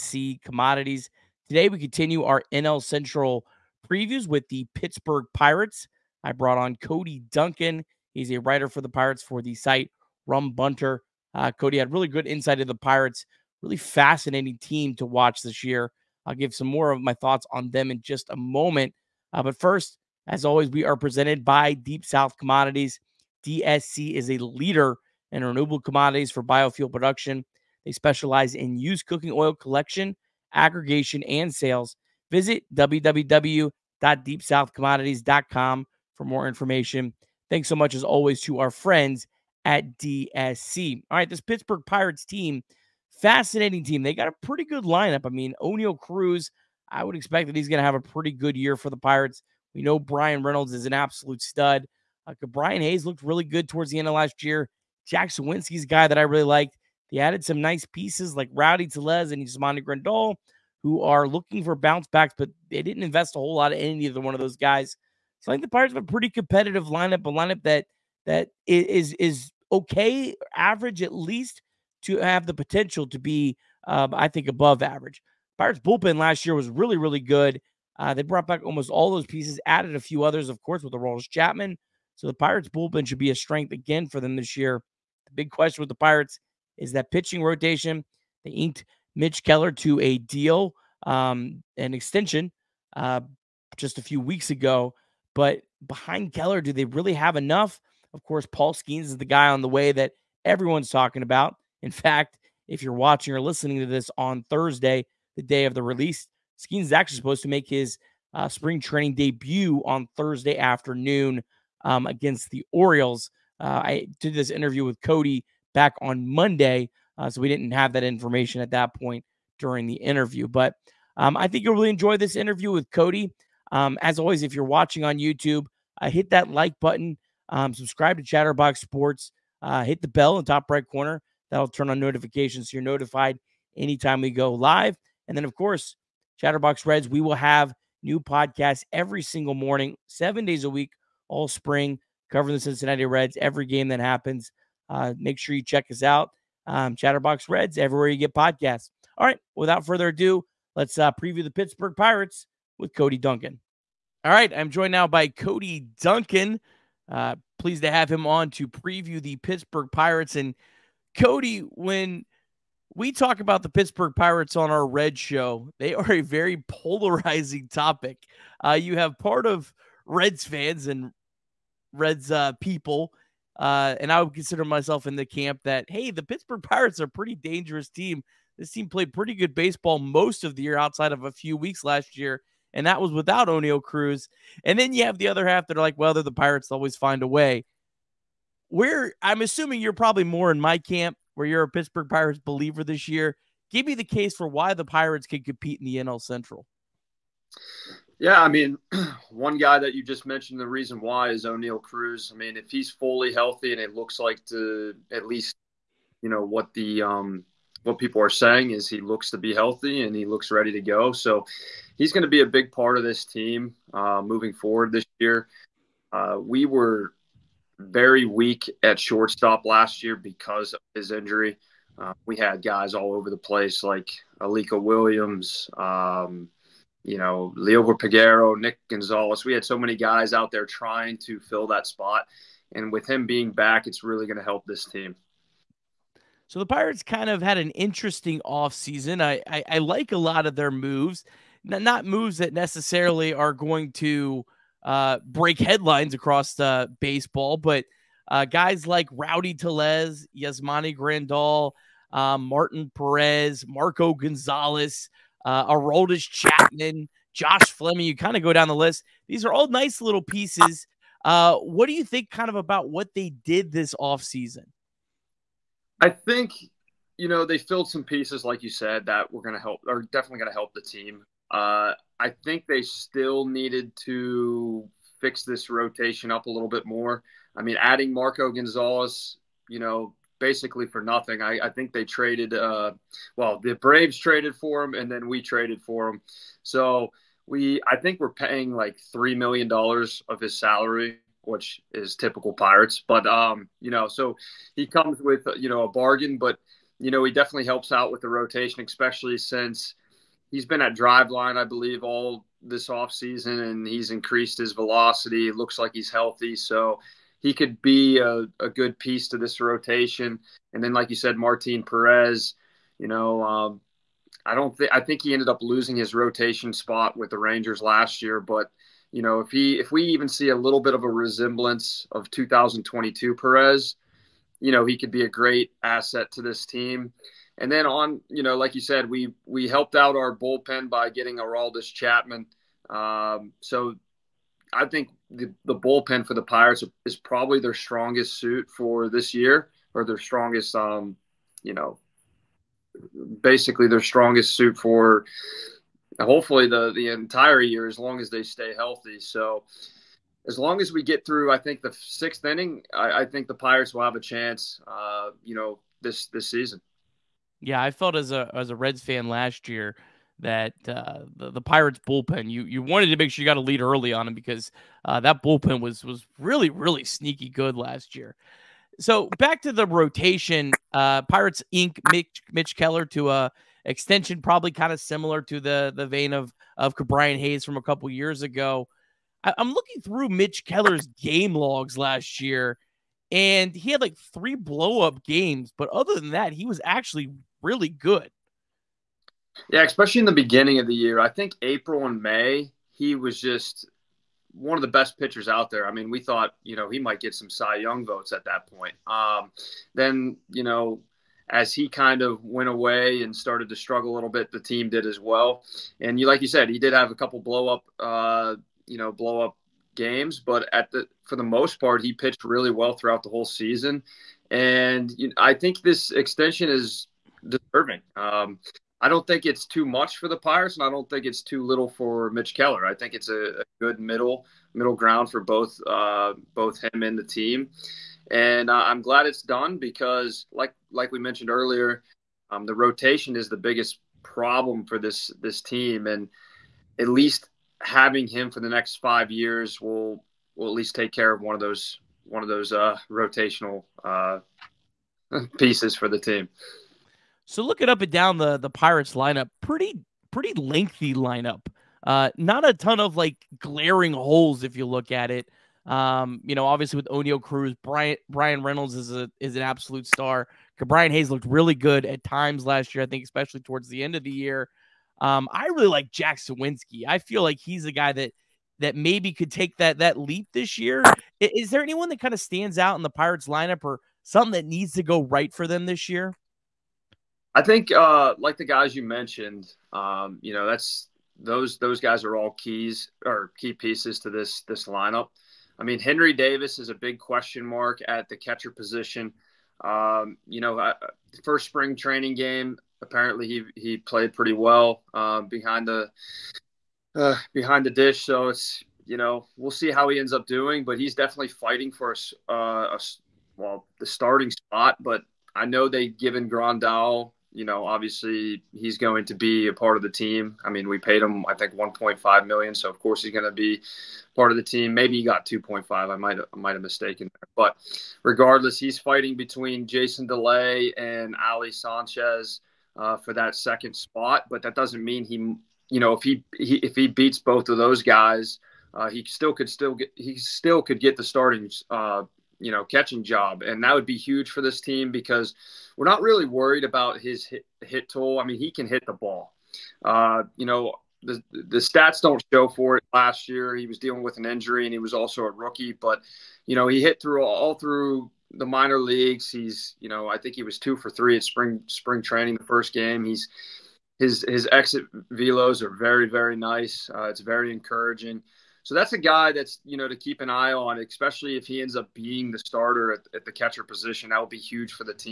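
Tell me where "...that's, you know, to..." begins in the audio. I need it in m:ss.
9:19.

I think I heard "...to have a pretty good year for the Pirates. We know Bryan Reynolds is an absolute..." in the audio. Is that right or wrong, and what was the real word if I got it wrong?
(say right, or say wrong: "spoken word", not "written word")
right.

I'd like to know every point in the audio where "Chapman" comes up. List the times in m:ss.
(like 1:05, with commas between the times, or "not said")
1:21, 4:16, 5:31.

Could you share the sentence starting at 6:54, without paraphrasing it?
And you know, I think this extension is deserving.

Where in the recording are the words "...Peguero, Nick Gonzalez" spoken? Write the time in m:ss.
3:47.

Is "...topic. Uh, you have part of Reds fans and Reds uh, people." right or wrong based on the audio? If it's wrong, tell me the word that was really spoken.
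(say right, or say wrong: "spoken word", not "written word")
right.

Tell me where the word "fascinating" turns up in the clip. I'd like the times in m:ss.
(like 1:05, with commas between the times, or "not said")
0:13, 0:43.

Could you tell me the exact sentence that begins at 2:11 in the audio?
That'll turn on notifications so you're notified anytime we go live.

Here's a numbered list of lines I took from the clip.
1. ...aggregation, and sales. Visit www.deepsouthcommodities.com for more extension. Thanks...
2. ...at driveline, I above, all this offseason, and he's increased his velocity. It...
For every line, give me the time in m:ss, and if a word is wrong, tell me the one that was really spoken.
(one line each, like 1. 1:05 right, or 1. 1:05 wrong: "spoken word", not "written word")
1. 0:30 wrong: "information", not "extension"
2. 5:00 wrong: "believe", not "above".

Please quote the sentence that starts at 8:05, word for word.
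I mean, Henry Davis is a big question mark at the catcher position.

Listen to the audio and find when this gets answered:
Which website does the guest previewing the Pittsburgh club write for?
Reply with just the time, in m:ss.
0:10.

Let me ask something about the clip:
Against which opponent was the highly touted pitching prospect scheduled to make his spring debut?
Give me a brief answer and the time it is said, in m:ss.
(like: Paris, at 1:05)
Orioles, at 1:52.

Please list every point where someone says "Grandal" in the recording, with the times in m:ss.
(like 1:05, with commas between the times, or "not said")
0:59, 4:10, 8:26.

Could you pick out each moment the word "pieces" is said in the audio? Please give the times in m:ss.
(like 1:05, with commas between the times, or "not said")
0:57, 1:19, 4:20, 4:28, 5:08, 7:25, 8:03.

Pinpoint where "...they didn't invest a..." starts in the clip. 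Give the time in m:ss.
1:02.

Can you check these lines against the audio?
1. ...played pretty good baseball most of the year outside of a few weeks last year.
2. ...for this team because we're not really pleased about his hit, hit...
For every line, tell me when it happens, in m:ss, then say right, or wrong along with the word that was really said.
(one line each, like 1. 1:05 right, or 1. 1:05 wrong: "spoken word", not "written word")
1. 2:58 right
2. 8:54 wrong: "worried", not "pleased".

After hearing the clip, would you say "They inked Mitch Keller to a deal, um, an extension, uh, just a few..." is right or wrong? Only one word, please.
right.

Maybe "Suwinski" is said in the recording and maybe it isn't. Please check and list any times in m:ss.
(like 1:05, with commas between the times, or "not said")
0:55, 7:46.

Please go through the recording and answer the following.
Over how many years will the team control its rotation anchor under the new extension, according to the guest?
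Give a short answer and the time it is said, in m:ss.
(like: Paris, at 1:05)
5, at 7:19.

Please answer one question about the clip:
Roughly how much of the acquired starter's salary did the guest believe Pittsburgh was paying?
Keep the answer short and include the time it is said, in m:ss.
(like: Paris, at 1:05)
3 million dollars, at 4:49.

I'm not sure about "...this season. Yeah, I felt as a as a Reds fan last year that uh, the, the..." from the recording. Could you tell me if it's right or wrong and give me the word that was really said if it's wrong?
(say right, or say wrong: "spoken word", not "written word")
right.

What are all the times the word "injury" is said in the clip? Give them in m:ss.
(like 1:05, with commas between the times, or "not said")
3:41, 9:04.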